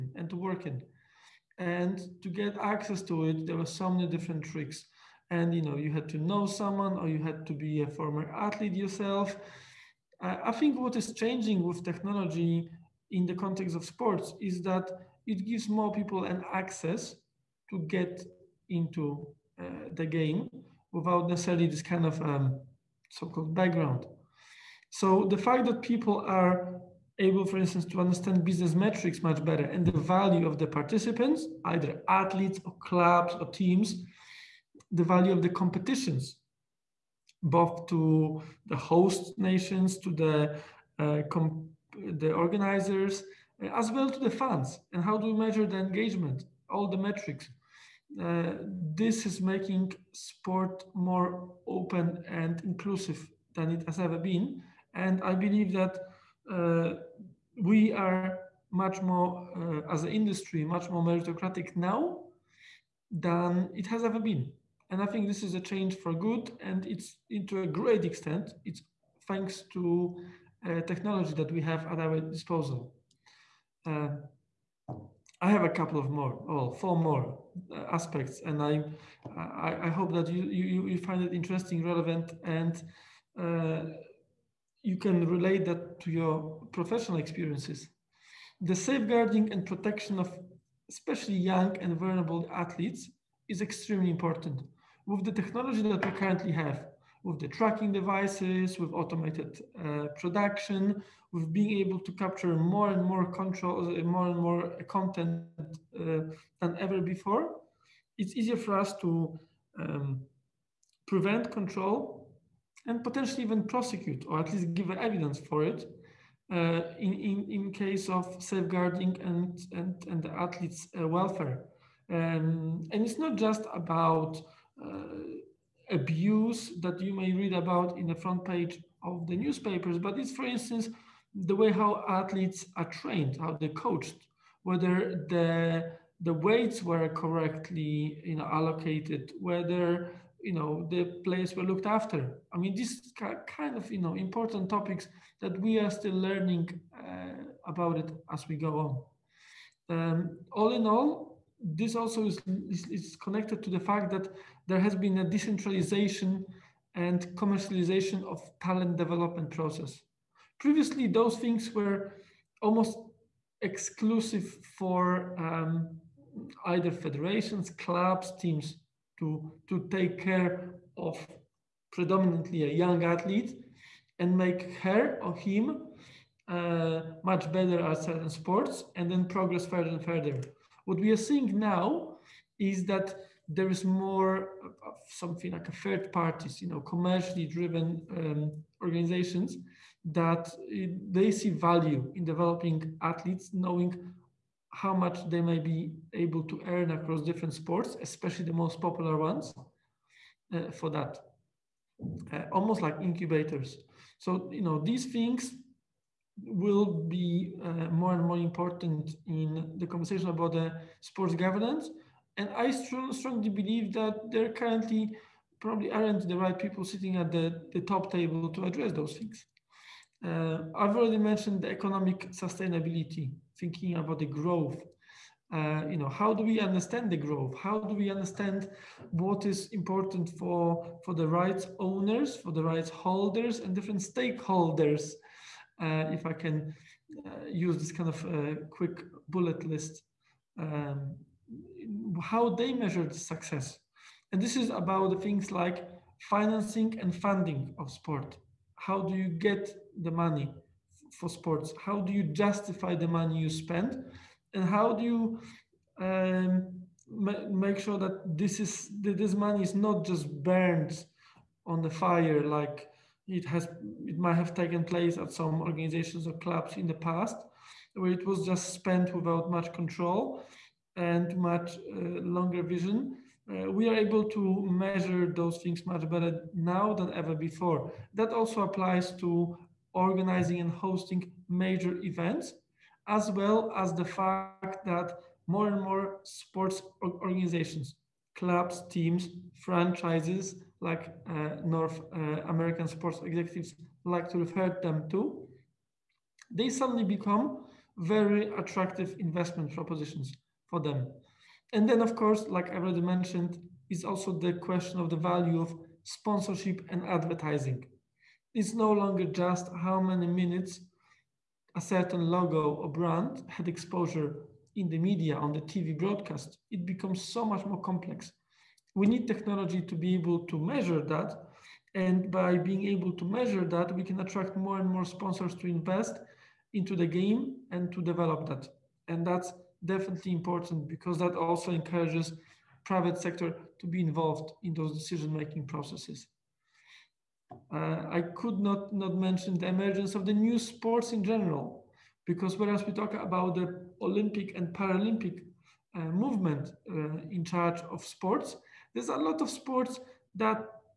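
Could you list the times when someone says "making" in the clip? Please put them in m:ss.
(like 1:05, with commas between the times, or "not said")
0:49, 5:34.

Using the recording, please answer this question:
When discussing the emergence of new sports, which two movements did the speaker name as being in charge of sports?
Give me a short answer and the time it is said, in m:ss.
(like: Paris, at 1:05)
Olympic and Paralympic, at 5:44.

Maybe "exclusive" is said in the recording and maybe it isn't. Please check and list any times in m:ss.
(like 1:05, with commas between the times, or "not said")
2:43.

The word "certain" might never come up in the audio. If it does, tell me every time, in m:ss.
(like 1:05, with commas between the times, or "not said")
2:58, 5:11.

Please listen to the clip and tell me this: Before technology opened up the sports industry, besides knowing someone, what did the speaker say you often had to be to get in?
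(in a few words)
a former athlete.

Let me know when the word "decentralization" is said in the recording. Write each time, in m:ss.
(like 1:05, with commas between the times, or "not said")
2:35.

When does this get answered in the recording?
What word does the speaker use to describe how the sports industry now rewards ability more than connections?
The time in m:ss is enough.
1:01.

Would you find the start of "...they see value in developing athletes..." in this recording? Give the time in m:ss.
3:11.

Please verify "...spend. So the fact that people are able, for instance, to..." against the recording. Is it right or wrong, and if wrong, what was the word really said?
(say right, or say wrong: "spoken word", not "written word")
wrong: "background", not "spend".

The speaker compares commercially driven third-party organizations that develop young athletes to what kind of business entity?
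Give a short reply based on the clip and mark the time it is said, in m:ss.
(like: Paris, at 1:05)
incubators, at 3:22.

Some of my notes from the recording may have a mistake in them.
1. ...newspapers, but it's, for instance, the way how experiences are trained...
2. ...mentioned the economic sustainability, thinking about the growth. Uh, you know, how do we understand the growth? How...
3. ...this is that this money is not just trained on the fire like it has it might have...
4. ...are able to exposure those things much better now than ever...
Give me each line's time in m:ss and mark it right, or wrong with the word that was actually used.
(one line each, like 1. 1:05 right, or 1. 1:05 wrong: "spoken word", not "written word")
1. 2:09 wrong: "athletes", not "experiences"
2. 3:41 right
3. 4:18 wrong: "burned", not "trained"
4. 4:33 wrong: "measure", not "exposure".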